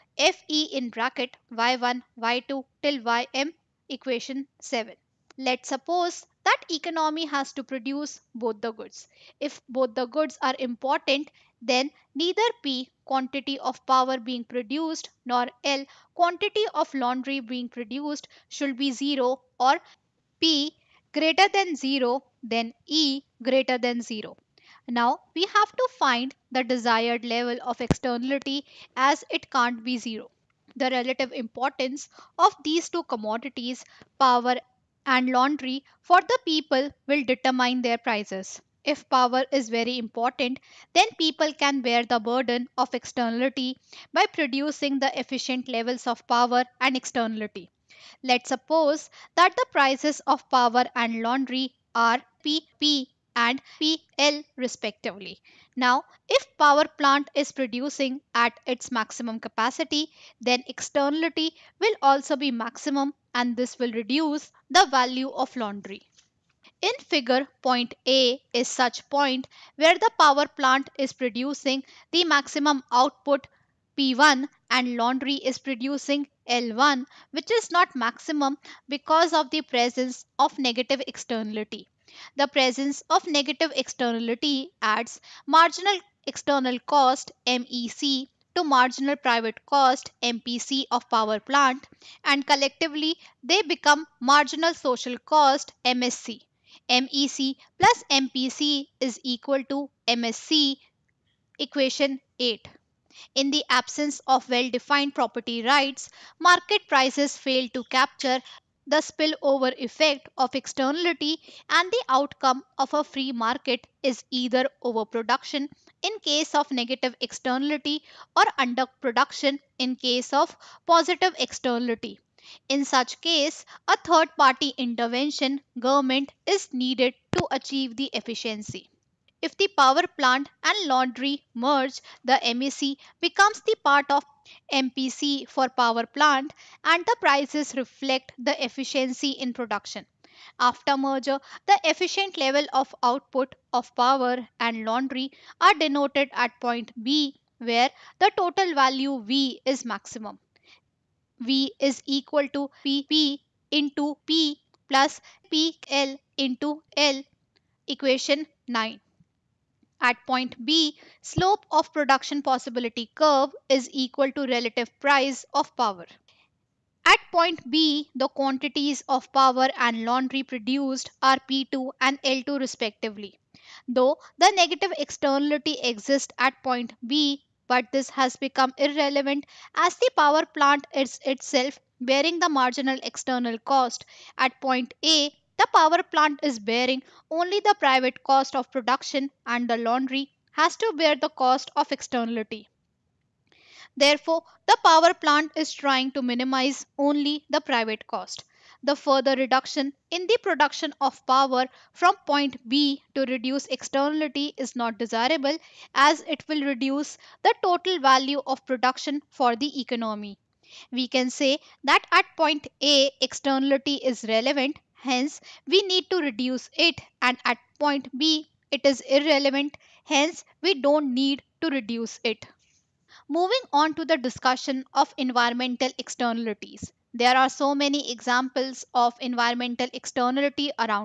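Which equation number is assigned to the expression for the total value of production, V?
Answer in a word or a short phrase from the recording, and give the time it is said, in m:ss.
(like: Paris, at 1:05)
9, at 2:37.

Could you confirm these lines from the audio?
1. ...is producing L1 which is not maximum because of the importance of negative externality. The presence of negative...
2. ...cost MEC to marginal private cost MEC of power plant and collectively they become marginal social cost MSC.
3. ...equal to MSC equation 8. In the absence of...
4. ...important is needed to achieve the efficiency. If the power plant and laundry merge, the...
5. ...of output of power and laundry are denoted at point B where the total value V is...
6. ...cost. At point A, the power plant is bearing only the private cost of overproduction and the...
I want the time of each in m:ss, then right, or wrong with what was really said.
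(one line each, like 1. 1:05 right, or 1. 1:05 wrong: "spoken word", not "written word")
1. 1:15 wrong: "presence", not "importance"
2. 1:26 wrong: "MPC", not "MEC"
3. 1:39 right
4. 2:05 wrong: "government", not "important"
5. 2:22 right
6. 3:03 wrong: "production", not "overproduction".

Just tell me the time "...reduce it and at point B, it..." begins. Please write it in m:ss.
3:36.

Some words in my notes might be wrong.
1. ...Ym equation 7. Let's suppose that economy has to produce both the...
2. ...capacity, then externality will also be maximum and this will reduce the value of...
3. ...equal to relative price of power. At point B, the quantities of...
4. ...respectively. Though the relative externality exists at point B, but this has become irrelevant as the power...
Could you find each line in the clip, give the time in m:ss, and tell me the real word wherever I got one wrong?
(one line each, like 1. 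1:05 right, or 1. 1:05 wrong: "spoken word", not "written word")
1. 0:03 right
2. 0:59 right
3. 2:43 right
4. 2:52 wrong: "negative", not "relative".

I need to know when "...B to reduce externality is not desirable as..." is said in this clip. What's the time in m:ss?
3:22.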